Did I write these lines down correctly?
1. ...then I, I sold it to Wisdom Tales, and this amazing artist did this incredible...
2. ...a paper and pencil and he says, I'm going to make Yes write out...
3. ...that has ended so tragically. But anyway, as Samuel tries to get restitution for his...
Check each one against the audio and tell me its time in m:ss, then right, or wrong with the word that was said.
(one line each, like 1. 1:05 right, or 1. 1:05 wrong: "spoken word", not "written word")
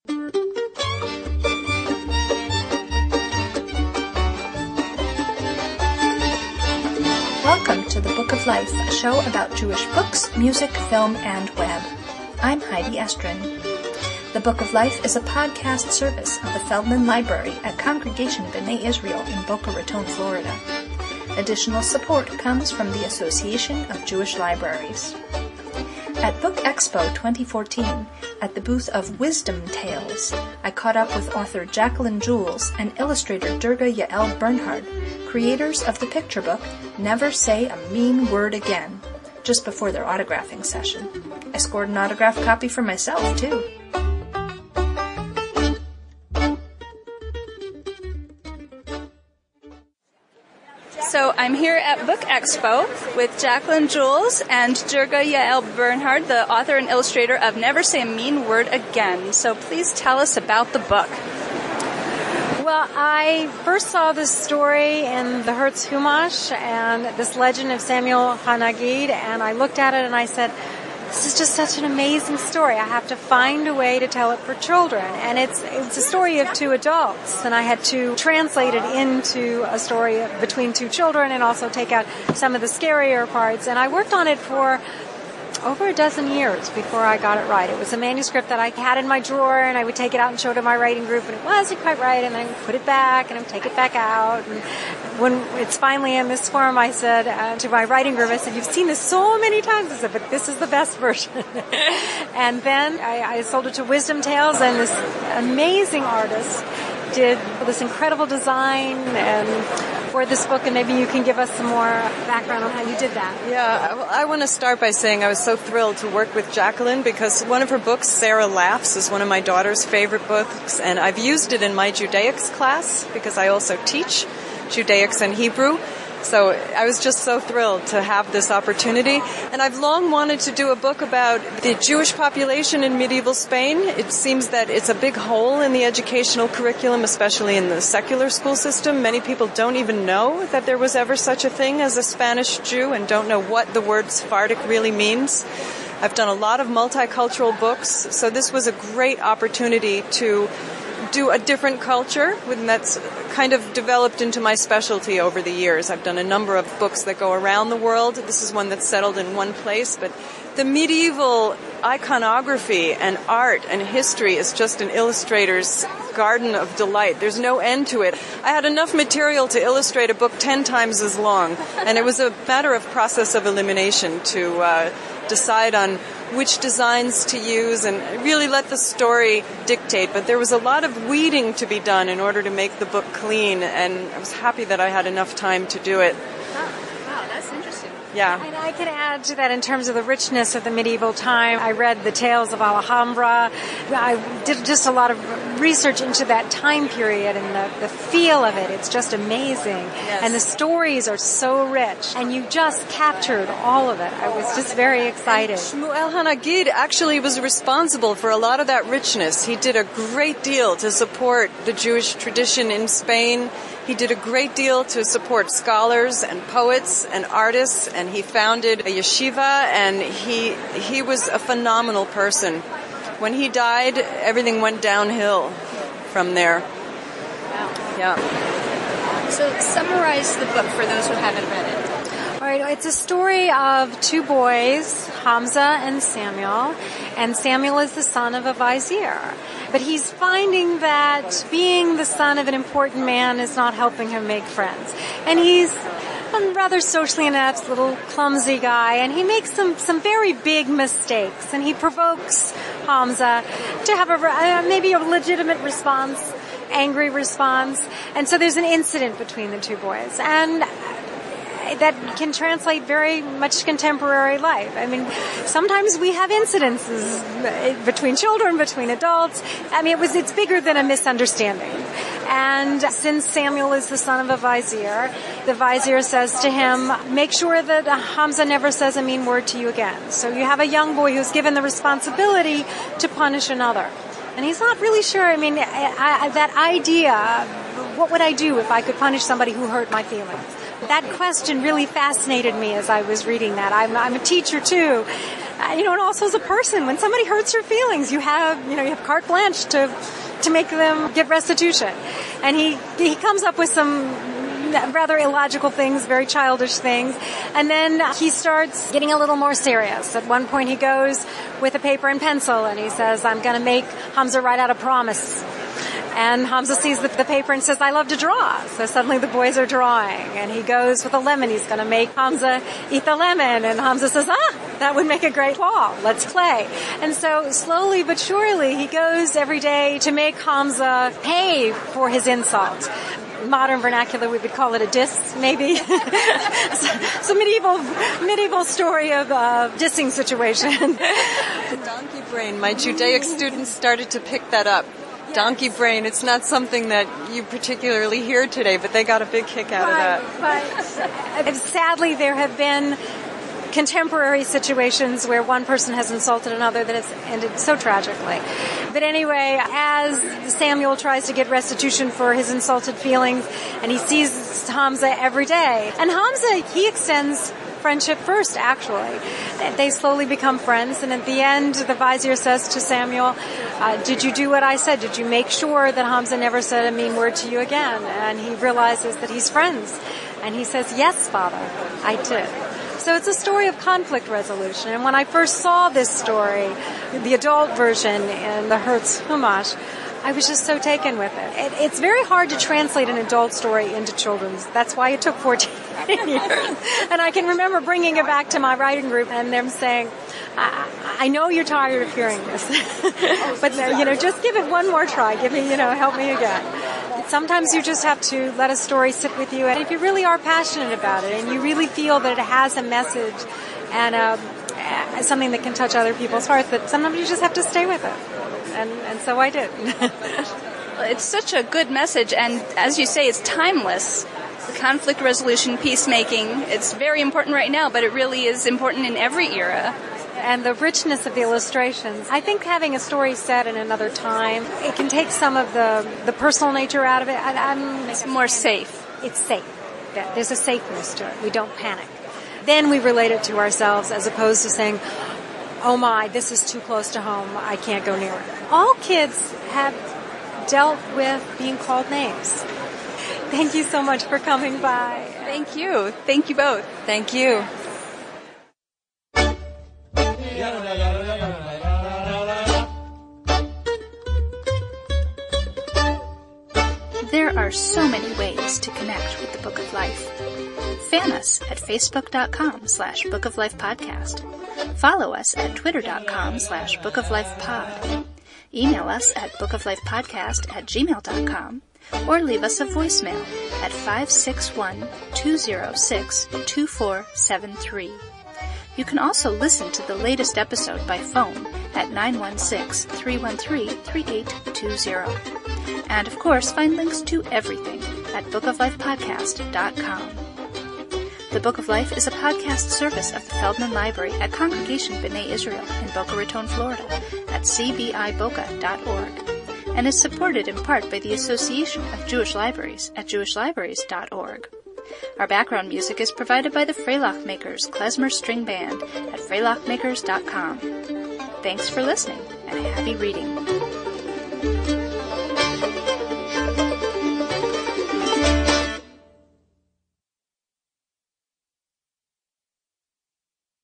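1. 1:42 right
2. 5:11 wrong: "Hamza", not "Yes"
3. 5:56 right.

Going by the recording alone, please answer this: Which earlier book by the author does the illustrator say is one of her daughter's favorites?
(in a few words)
Sarah Laughs.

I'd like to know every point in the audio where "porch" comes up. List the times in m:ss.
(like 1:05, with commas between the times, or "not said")
not said.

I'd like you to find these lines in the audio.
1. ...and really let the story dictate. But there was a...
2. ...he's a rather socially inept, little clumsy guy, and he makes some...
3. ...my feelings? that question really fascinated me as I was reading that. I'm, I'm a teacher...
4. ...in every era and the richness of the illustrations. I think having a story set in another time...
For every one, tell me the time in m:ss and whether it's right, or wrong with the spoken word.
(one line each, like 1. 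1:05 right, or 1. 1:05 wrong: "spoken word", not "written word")
1. 2:57 right
2. 4:05 right
3. 4:49 right
4. 7:09 right.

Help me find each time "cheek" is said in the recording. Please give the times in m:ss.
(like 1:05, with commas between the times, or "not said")
not said.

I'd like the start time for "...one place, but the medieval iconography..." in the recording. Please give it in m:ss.
2:39.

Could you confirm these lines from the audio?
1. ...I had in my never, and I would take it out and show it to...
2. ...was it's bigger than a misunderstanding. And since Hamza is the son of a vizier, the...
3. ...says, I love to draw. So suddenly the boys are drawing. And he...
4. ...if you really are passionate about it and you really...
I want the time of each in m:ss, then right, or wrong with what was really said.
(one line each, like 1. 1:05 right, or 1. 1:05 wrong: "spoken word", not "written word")
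1. 1:28 wrong: "drawer", not "never"
2. 4:29 wrong: "Samuel", not "Hamza"
3. 5:17 right
4. 6:49 right.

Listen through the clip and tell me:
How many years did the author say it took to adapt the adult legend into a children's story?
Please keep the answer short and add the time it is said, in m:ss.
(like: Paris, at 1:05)
14, at 6:35.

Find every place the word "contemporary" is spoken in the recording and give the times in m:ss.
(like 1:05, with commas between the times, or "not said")
4:23, 5:53.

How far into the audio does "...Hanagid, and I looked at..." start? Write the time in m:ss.
1:08.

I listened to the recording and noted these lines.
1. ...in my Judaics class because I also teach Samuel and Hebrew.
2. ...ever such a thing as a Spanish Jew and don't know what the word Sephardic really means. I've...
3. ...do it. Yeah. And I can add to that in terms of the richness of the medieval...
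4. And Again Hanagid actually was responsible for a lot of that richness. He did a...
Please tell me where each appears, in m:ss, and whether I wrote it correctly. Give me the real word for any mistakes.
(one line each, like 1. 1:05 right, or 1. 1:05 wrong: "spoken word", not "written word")
1. 2:01 wrong: "Judaics", not "Samuel"
2. 2:20 right
3. 3:05 right
4. 3:25 wrong: "Shmuel", not "Again".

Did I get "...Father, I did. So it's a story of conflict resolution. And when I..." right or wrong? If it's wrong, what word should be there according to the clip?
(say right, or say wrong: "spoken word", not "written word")
right.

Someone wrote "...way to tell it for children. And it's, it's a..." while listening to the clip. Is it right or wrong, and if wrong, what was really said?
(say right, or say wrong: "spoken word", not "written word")
right.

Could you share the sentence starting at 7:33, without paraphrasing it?
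Thank you so much for coming by.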